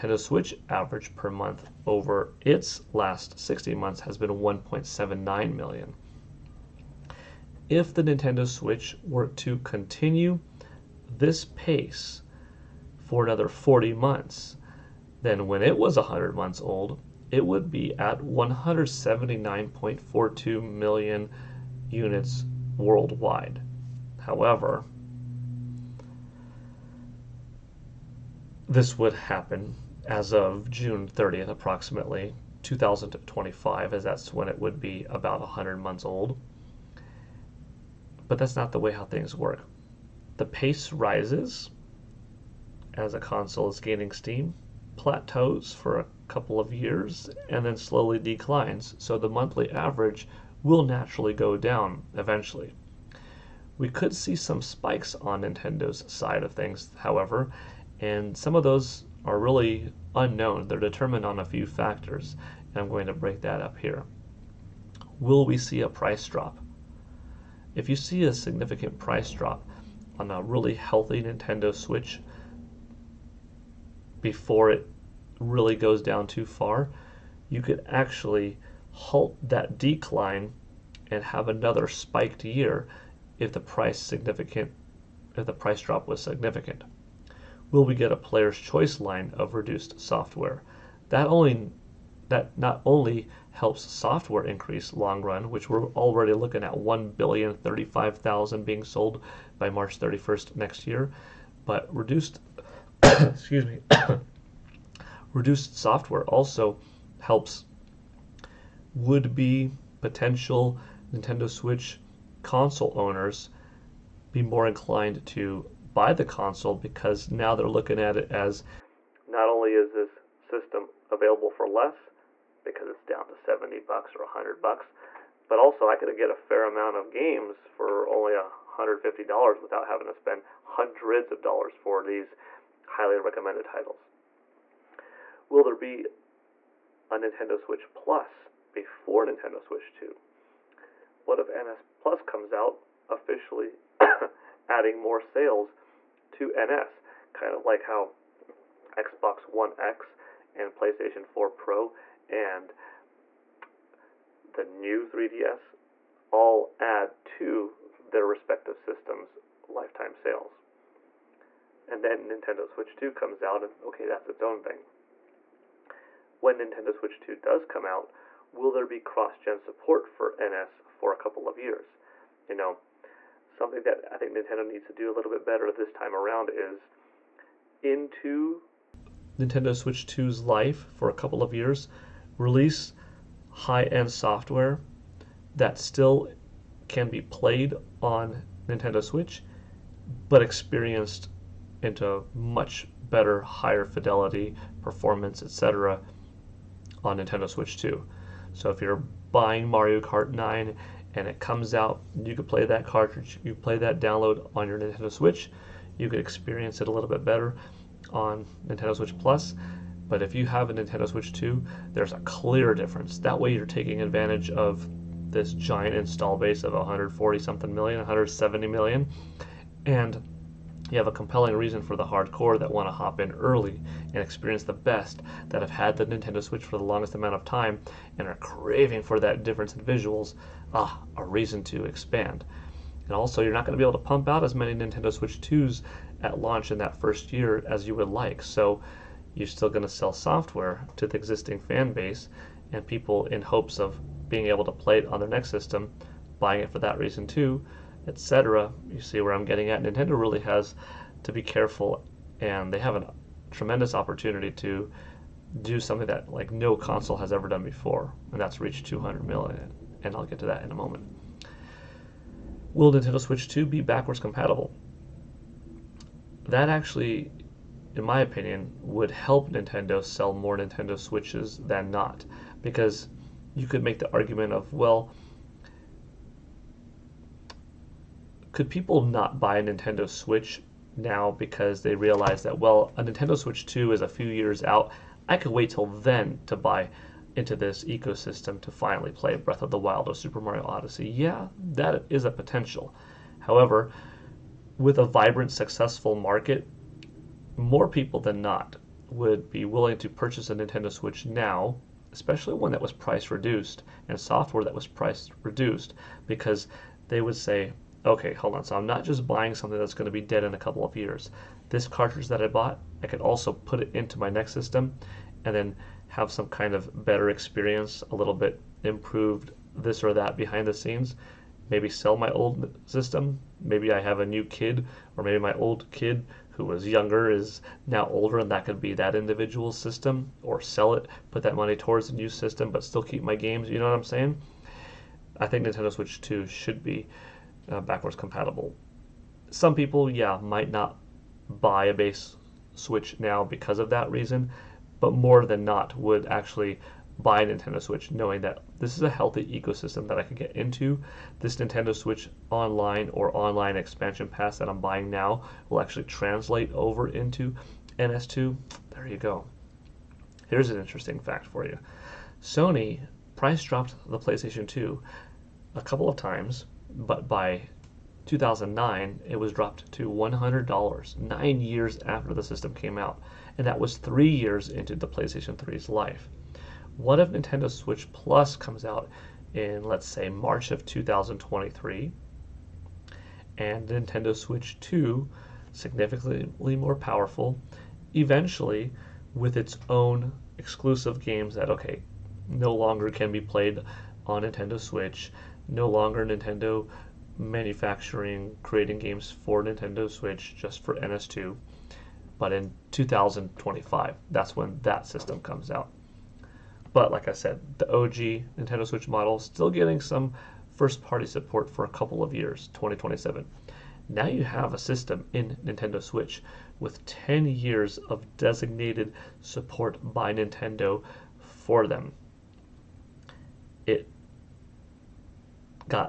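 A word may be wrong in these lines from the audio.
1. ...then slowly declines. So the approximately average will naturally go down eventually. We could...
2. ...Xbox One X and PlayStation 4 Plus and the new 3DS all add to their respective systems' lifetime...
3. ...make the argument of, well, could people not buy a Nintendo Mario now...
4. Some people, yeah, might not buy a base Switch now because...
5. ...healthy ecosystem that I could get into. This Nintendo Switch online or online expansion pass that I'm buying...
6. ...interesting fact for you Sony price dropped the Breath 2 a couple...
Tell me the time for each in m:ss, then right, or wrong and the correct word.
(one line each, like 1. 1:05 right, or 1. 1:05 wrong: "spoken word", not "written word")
1. 0:47 wrong: "monthly", not "approximately"
2. 2:28 wrong: "Pro", not "Plus"
3. 4:33 wrong: "Switch", not "Mario"
4. 5:39 right
5. 5:49 right
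6. 6:00 wrong: "PlayStation", not "Breath".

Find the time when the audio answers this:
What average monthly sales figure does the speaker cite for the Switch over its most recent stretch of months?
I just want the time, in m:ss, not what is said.
0:04.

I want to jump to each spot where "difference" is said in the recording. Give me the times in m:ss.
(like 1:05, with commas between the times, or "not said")
3:32, 3:49.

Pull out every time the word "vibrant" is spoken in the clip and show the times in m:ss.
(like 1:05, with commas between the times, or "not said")
4:55.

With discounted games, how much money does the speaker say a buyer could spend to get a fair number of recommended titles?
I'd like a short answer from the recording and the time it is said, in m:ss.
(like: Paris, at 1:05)
$150, at 2:08.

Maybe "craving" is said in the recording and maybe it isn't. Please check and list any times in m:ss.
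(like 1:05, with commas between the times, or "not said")
3:48.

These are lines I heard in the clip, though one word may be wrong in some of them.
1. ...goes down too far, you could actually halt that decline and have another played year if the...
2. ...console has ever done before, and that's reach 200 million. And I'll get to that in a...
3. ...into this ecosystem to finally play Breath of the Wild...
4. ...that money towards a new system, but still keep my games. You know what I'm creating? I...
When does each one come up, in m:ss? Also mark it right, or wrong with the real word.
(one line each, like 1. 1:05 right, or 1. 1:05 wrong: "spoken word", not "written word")
1. 1:15 wrong: "spiked", not "played"
2. 4:16 right
3. 4:47 right
4. 5:31 wrong: "saying", not "creating".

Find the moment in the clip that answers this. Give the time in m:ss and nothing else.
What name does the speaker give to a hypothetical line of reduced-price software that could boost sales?
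1:28.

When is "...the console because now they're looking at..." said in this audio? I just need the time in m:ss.
1:56.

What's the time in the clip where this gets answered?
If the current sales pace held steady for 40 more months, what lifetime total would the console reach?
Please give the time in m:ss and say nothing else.
0:18.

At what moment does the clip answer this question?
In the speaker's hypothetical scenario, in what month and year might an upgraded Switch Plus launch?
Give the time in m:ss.
6:20.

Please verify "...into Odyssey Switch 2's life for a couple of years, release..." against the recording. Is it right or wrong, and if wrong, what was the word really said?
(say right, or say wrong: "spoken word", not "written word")
wrong: "Nintendo", not "Odyssey".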